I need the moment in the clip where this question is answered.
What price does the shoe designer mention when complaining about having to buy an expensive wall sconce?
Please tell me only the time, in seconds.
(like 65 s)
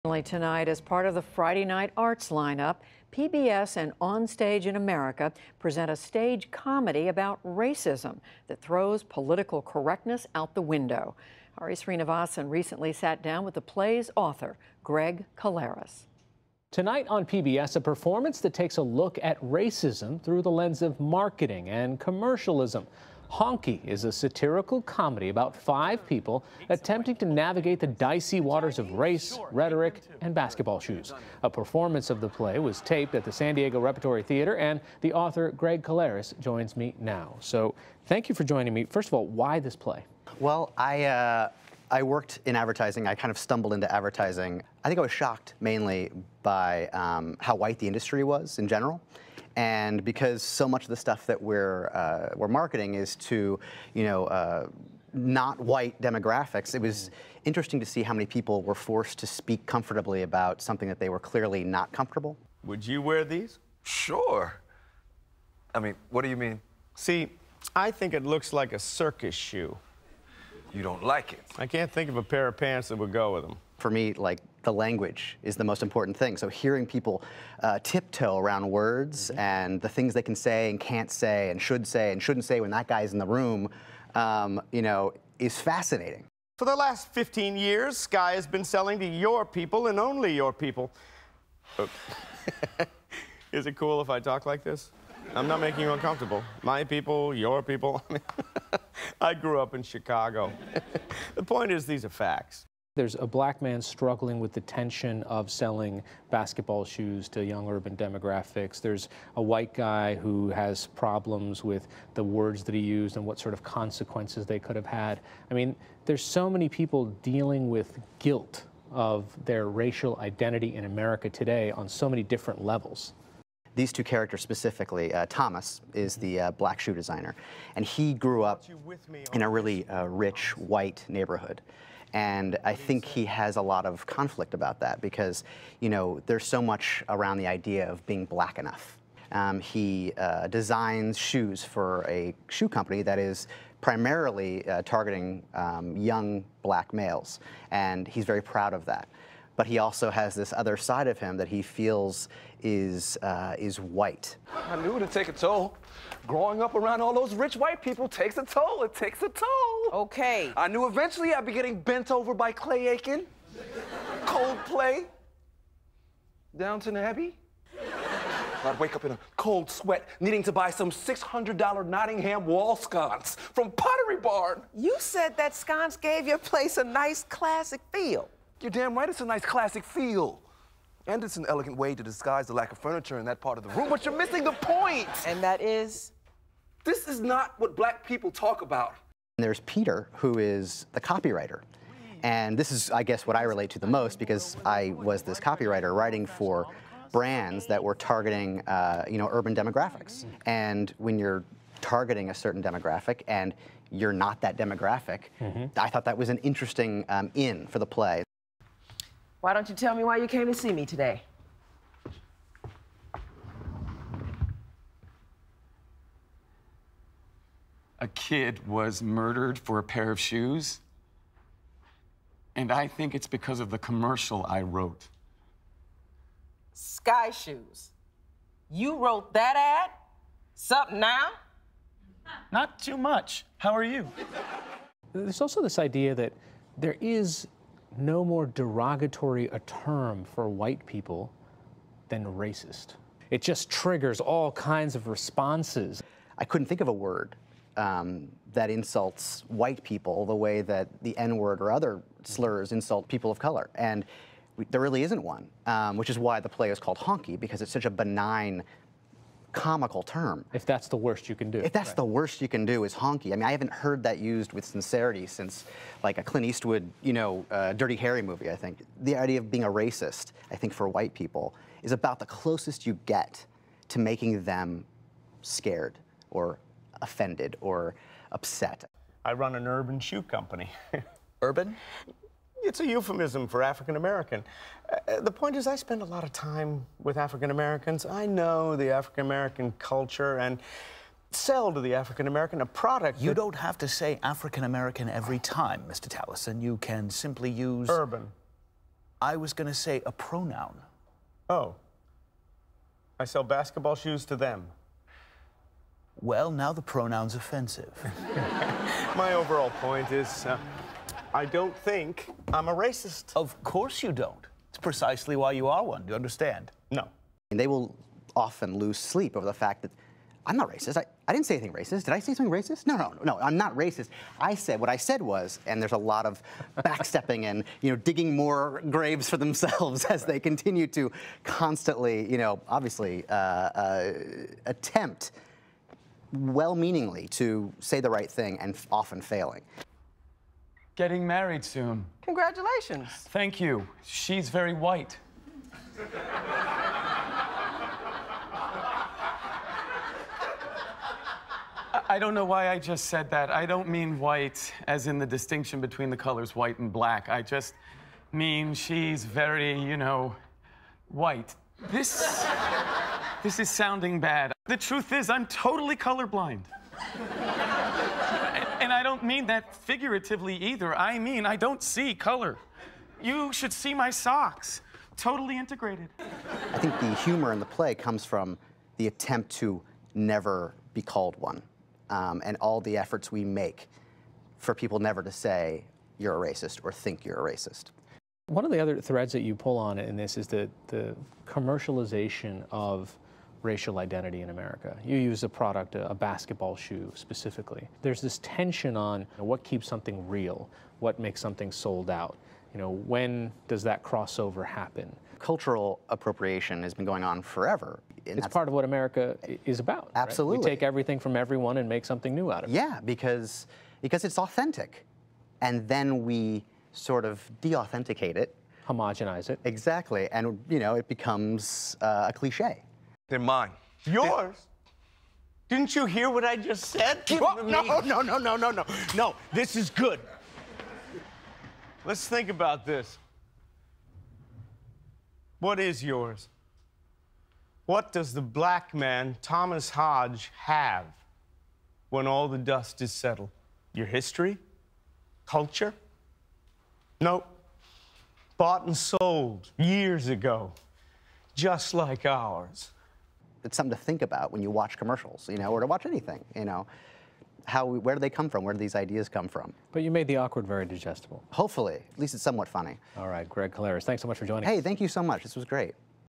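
170 s.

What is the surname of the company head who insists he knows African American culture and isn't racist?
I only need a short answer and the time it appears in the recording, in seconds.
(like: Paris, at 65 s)
Tallison, at 296 s.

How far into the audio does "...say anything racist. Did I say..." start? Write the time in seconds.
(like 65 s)
321 s.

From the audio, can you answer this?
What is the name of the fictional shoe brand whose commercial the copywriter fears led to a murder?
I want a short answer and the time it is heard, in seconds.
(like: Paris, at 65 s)
Sky Shoes, at 226 s.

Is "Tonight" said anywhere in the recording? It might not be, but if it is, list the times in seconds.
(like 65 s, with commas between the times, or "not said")
0 s, 16 s.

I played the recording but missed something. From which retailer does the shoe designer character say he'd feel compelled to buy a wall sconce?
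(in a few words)
Pottery Barn.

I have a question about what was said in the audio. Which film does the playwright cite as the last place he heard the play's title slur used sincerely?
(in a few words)
Dirty Harry.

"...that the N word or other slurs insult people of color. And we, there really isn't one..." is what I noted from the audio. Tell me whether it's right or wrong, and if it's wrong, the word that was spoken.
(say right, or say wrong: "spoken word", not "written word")
right.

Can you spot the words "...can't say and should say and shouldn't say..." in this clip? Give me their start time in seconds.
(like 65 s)
80 s.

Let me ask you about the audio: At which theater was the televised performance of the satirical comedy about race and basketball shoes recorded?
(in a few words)
San Diego Repertory Theater.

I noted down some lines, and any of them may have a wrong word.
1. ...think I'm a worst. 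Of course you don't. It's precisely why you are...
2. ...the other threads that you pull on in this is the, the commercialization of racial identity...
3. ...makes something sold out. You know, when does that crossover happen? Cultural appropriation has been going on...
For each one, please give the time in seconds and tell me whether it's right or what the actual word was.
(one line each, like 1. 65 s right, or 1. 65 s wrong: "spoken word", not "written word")
1. 311 s wrong: "racist", not "worst"
2. 388 s right
3. 401 s right.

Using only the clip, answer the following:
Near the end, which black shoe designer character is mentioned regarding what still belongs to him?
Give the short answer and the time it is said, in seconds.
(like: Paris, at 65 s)
Thomas Hodge, at 439 s.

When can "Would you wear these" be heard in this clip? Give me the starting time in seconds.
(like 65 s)
62 s.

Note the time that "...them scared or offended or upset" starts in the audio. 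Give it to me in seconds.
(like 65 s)
274 s.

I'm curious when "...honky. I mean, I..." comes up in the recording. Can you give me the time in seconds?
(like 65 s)
262 s.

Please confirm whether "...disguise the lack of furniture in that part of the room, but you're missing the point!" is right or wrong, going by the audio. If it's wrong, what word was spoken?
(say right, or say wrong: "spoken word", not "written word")
right.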